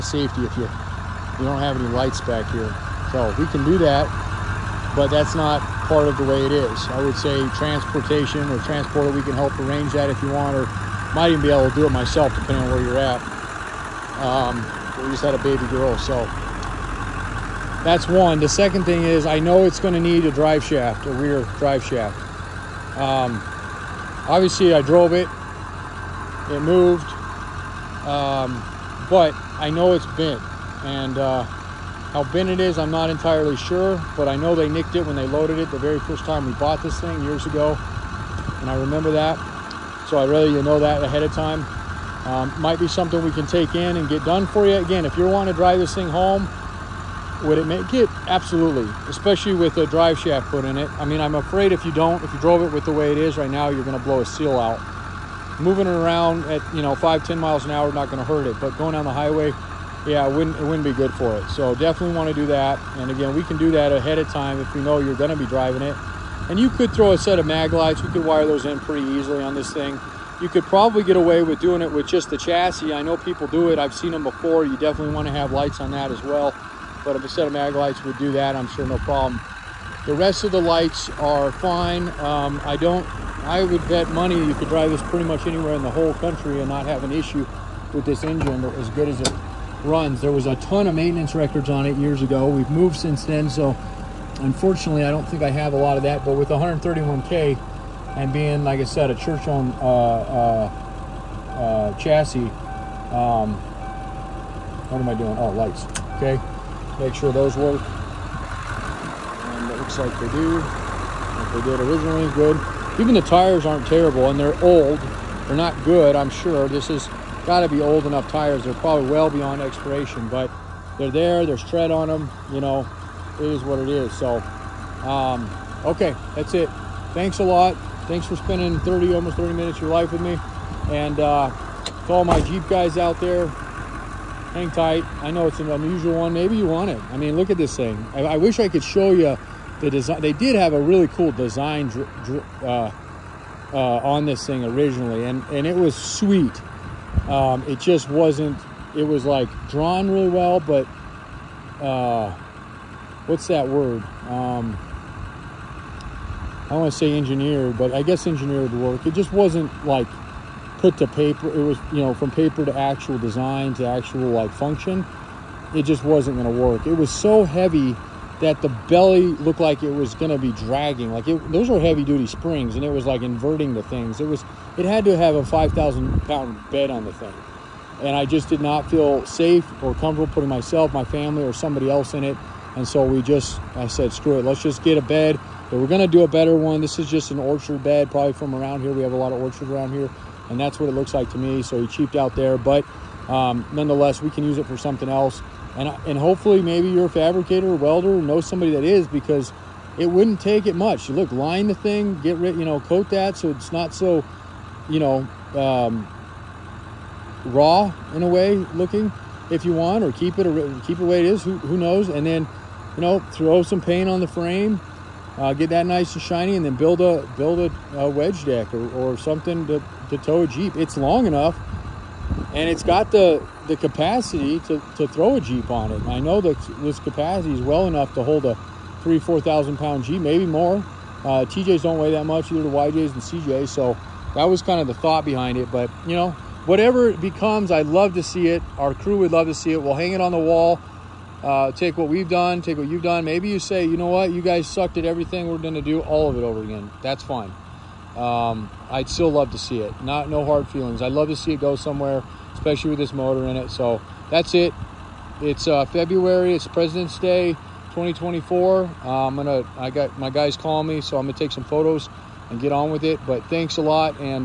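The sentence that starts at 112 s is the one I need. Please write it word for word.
Even the tires aren't terrible and they're old.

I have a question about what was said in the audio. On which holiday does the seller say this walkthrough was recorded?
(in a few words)
Presidents' Day.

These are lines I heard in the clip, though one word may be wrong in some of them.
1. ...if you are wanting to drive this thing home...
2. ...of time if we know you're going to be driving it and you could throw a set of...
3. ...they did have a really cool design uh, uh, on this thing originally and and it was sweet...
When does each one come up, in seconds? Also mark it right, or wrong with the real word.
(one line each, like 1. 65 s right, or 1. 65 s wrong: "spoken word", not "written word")
1. 45 s right
2. 64 s right
3. 140 s right.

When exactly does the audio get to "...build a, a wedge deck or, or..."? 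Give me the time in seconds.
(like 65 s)
217 s.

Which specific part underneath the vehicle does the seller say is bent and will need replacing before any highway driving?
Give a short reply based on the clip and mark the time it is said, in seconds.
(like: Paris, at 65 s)
Rear drive shaft, at 21 s.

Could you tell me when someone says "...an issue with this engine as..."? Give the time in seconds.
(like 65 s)
87 s.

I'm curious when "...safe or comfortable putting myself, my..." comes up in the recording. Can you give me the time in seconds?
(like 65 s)
179 s.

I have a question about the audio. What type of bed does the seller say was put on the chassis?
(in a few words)
Orchard bed.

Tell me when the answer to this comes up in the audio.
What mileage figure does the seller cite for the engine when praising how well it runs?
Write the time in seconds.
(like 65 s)
96 s.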